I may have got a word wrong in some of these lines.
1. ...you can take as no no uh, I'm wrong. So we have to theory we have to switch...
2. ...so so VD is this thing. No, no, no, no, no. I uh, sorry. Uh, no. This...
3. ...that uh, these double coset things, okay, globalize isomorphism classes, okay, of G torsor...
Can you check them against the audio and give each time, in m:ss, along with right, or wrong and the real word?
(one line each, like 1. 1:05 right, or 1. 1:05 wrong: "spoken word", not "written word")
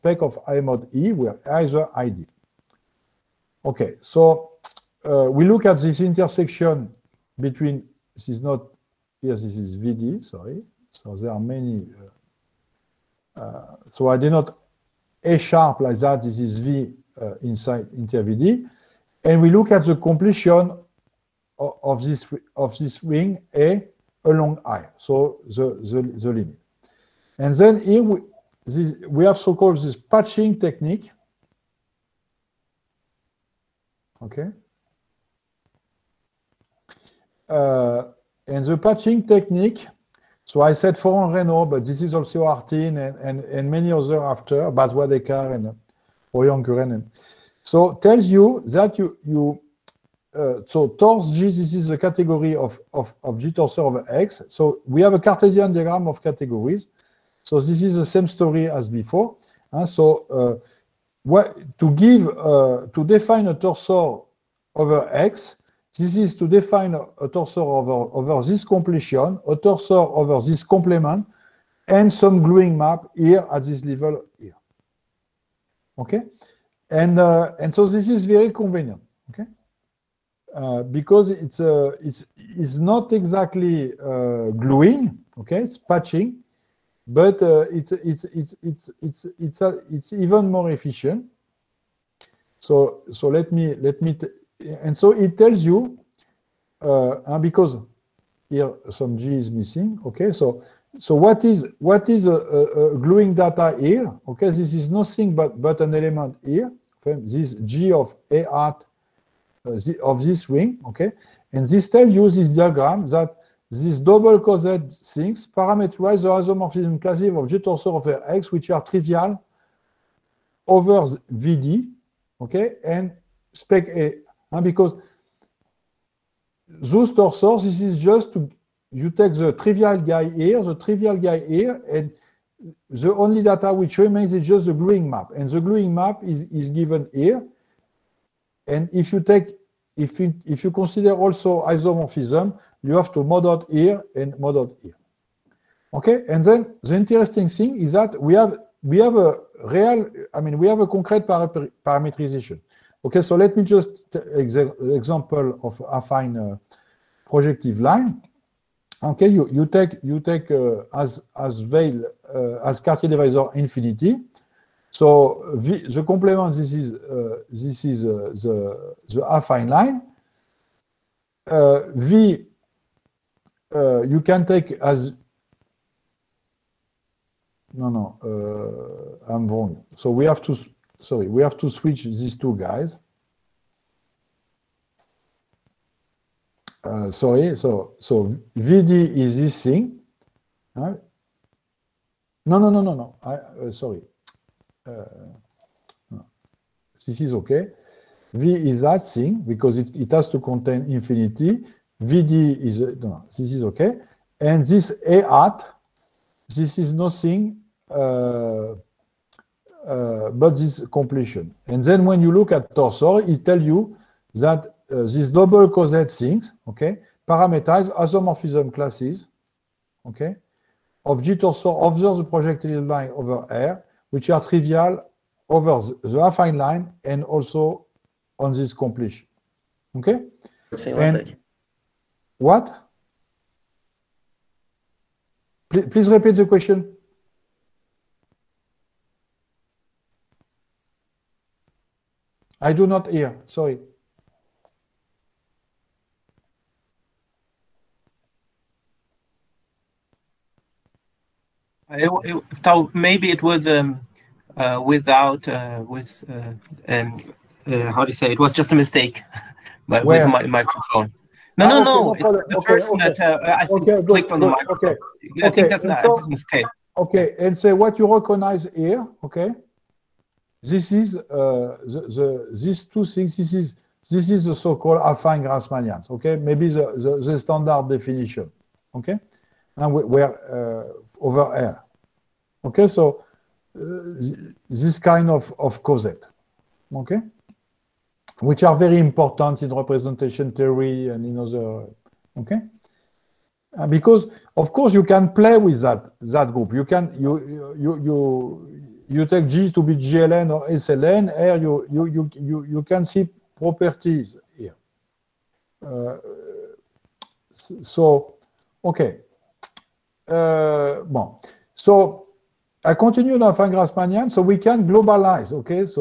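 1. 2:54 wrong: "sorry", not "theory"
2. 3:07 right
3. 3:34 wrong: "parameterize", not "globalize".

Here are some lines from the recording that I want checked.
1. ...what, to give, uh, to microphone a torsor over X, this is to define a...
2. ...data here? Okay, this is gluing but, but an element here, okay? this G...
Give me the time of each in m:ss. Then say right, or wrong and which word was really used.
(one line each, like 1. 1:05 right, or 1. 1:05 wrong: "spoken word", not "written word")
1. 1:01 wrong: "define", not "microphone"
2. 1:43 wrong: "nothing", not "gluing".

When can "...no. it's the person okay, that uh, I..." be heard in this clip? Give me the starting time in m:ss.
4:22.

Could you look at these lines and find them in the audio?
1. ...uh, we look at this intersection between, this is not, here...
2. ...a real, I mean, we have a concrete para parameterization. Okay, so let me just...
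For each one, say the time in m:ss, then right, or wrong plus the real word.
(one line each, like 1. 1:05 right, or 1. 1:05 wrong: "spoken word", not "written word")
1. 0:05 right
2. 2:29 right.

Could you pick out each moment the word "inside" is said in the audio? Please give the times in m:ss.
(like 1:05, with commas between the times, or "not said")
0:17.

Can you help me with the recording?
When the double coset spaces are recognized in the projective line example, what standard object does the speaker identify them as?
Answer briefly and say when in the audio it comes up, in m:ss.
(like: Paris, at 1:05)
Affine Grassmannians, at 4:35.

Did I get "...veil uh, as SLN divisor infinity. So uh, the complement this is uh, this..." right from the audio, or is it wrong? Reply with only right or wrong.
wrong.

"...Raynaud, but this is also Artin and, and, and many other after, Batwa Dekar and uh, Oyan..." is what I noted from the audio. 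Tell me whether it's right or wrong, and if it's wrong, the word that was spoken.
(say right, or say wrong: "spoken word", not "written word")
right.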